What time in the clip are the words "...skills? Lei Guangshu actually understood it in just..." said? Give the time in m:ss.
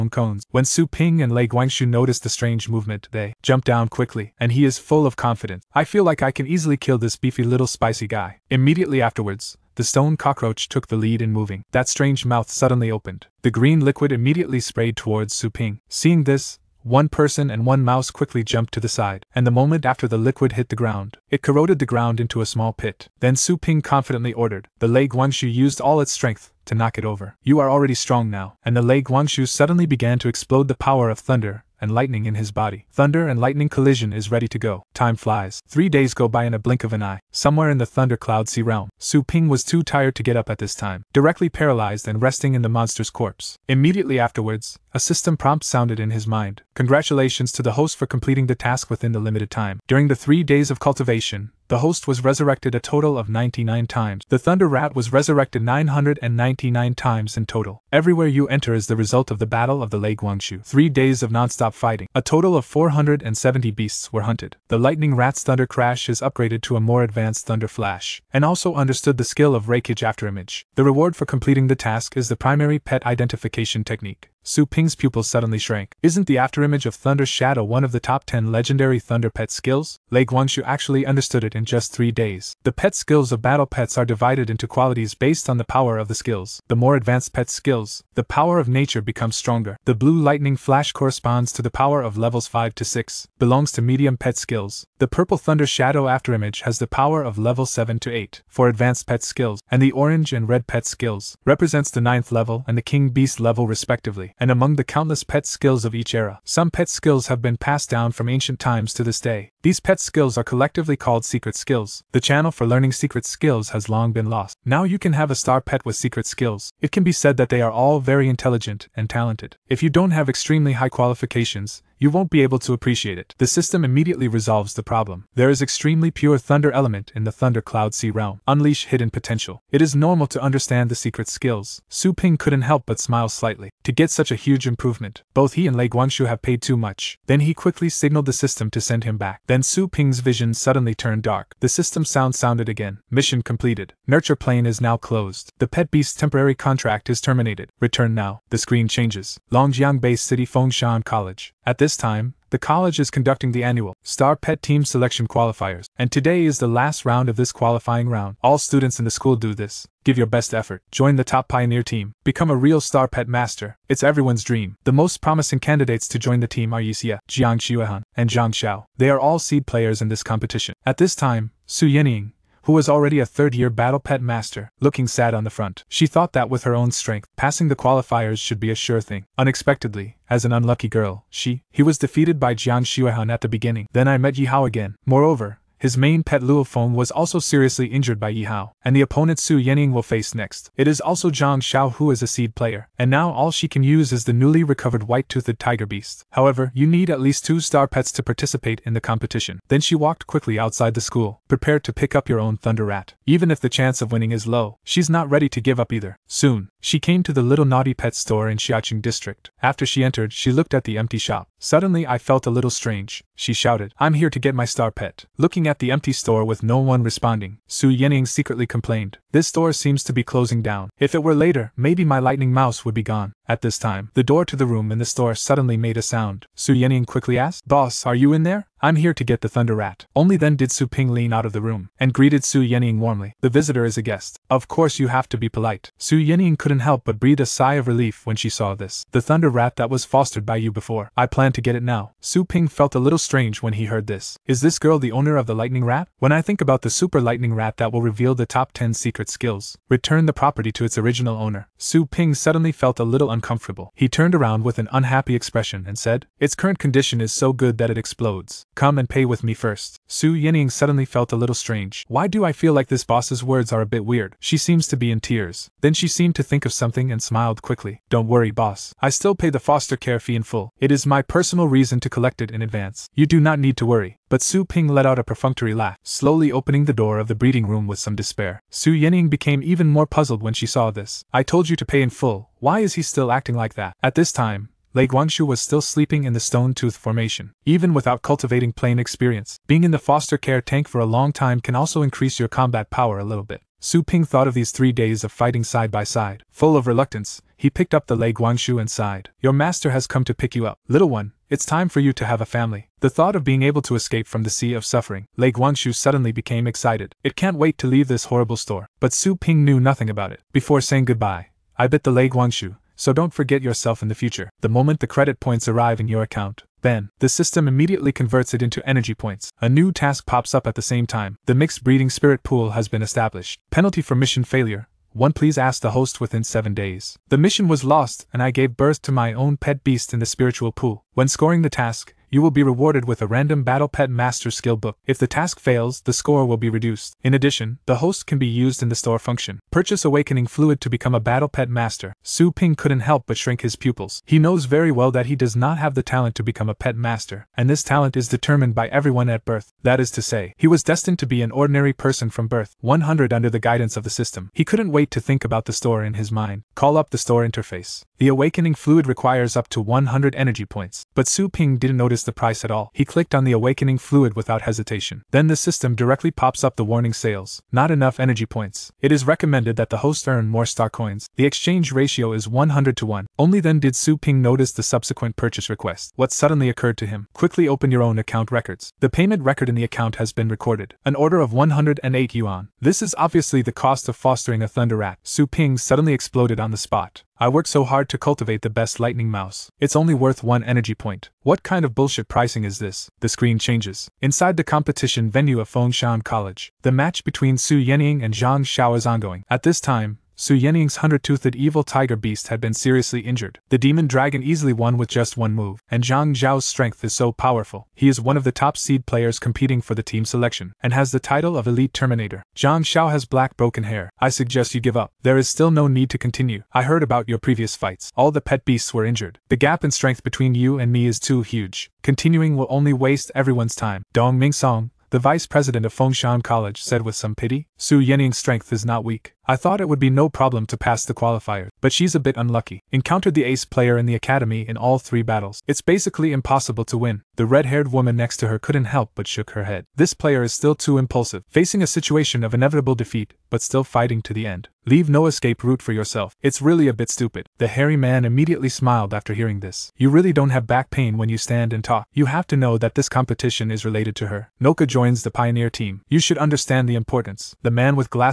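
1:19.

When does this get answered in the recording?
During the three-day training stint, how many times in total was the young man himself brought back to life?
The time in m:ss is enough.
0:53.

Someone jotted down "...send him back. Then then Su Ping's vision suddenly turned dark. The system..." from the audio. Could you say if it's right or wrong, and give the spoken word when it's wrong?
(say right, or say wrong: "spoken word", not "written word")
right.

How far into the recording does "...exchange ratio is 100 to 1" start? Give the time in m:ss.
6:11.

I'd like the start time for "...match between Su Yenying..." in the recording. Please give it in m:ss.
6:36.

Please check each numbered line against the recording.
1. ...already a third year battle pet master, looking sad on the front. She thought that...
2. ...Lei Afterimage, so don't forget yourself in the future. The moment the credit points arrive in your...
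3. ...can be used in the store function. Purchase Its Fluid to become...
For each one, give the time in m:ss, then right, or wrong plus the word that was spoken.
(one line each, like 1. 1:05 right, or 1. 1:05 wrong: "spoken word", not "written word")
1. 2:52 right
2. 5:12 wrong: "Guangshu", not "Afterimage"
3. 5:38 wrong: "Awakening", not "Its".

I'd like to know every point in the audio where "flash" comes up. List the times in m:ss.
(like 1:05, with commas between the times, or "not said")
1:07, 1:30.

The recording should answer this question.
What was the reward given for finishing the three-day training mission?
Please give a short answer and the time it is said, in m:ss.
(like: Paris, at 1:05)
primary pet identification technique, at 1:12.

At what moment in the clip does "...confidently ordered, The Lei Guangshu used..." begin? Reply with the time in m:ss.
0:23.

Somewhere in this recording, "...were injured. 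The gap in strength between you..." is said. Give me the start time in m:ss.
6:58.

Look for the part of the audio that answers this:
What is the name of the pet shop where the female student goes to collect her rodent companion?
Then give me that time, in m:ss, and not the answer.
3:27.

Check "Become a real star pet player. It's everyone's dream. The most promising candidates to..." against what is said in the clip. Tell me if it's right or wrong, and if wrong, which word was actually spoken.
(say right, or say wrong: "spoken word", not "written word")
wrong: "master", not "player".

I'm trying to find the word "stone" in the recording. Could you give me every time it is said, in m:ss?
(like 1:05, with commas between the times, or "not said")
0:09, 4:46.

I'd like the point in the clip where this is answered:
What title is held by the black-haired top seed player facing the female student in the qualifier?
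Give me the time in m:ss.
6:51.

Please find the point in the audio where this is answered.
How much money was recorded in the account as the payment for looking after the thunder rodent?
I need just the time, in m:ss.
6:21.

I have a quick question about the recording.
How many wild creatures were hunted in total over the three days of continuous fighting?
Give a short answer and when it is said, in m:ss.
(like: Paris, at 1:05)
470, at 1:02.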